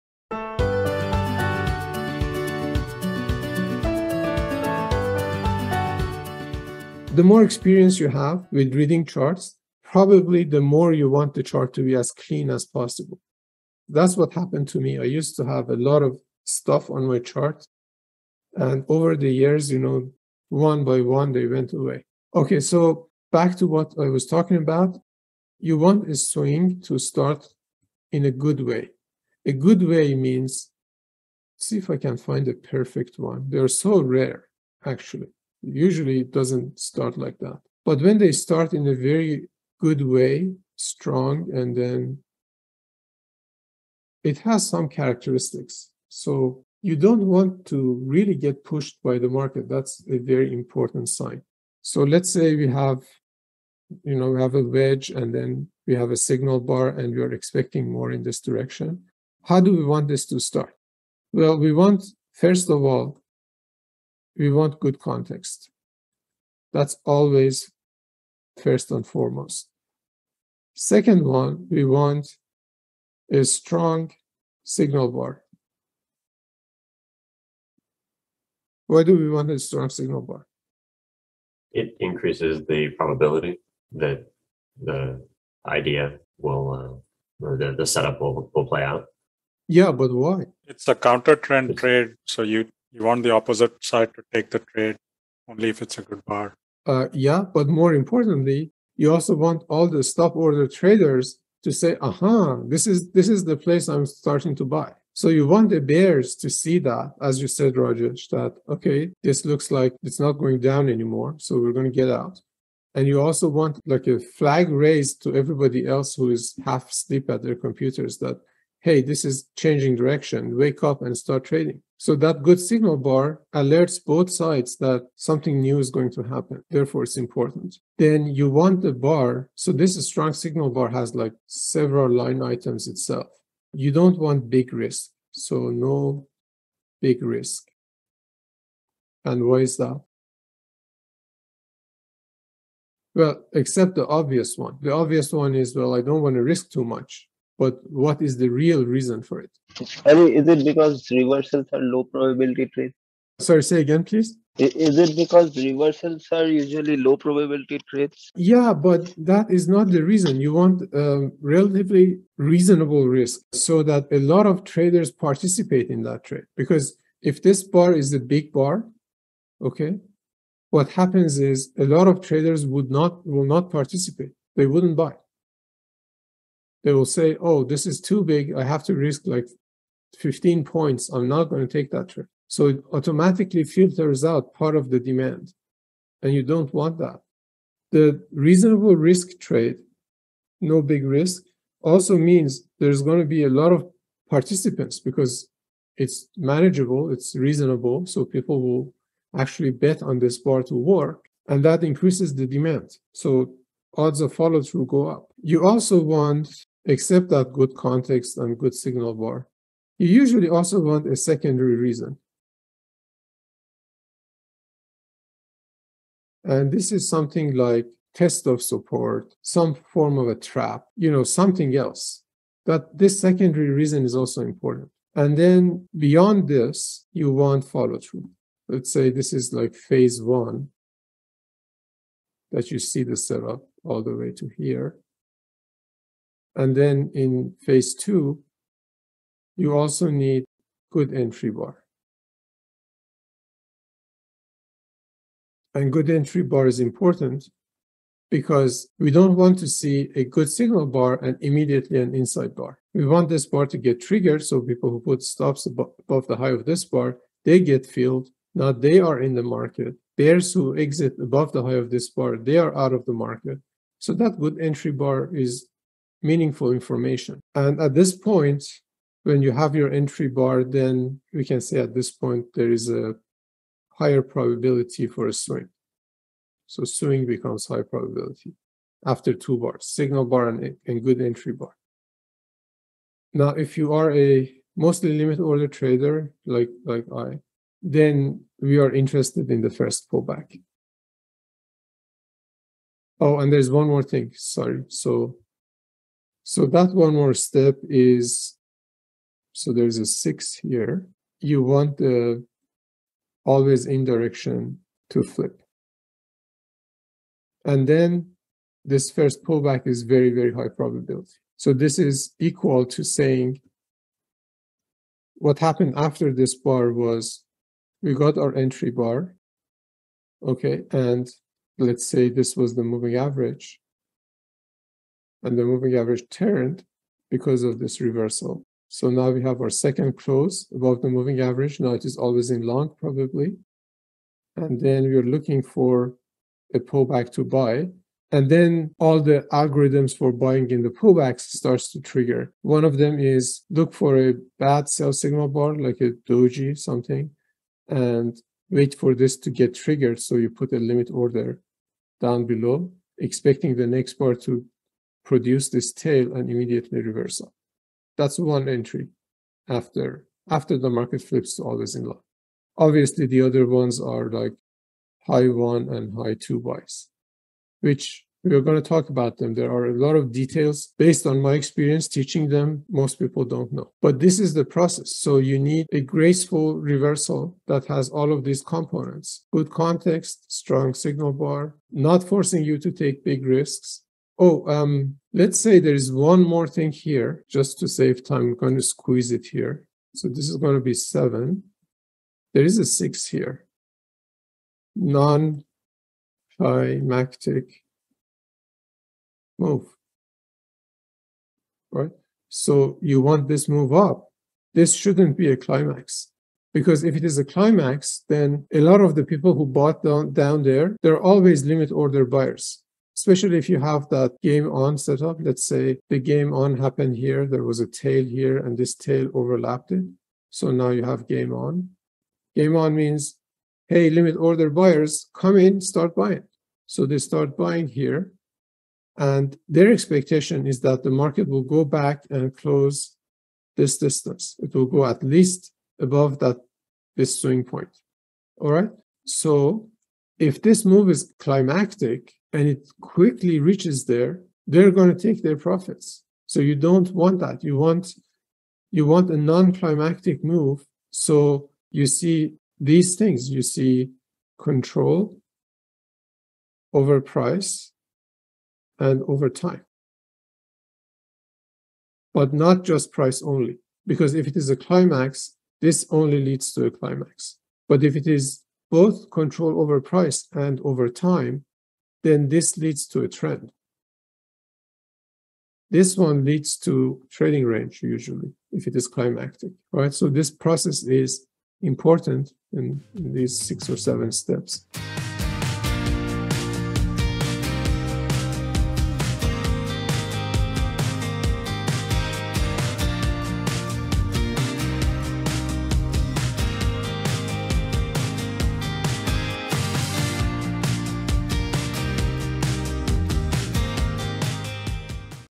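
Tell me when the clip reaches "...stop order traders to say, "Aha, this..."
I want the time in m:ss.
1:40.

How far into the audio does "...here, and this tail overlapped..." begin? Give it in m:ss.
6:58.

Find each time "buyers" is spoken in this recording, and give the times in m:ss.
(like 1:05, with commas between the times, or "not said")
6:52, 7:04.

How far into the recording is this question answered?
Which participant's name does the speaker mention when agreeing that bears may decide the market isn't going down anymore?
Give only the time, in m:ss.
1:47.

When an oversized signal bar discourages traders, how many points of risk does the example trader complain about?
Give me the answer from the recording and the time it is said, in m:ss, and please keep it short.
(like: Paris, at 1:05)
15 points, at 3:00.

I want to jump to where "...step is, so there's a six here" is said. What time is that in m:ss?
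4:57.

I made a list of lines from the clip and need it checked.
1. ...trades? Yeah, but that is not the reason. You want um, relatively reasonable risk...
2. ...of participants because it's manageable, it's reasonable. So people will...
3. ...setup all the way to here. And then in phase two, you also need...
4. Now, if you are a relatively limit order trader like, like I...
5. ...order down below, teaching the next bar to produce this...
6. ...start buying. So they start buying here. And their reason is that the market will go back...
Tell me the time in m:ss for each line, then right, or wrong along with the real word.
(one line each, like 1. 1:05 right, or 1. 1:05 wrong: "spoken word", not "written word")
1. 2:37 right
2. 3:13 right
3. 3:53 right
4. 4:43 wrong: "mostly", not "relatively"
5. 5:51 wrong: "expecting", not "teaching"
6. 7:05 wrong: "expectation", not "reason".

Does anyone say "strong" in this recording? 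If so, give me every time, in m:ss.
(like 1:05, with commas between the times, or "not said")
0:40, 1:13, 1:19, 2:10, 6:20.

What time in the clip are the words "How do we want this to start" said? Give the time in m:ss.
0:59.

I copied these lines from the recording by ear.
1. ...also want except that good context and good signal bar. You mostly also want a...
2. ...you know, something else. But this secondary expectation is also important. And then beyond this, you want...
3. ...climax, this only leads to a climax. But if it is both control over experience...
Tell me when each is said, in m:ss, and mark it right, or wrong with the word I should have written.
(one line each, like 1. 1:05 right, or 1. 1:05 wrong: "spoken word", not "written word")
1. 3:25 wrong: "usually", not "mostly"
2. 3:40 wrong: "reason", not "expectation"
3. 7:44 wrong: "price", not "experience".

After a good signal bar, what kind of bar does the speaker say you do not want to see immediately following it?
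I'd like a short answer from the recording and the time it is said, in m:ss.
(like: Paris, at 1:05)
inside bar, at 4:12.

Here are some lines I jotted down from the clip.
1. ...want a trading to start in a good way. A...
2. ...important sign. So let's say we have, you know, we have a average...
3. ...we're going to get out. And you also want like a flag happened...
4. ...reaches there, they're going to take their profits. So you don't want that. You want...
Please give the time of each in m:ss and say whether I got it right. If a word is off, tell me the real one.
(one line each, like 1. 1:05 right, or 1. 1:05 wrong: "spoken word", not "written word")
1. 0:25 wrong: "swing", not "trading"
2. 0:50 wrong: "wedge", not "average"
3. 1:51 wrong: "raised", not "happened"
4. 7:23 right.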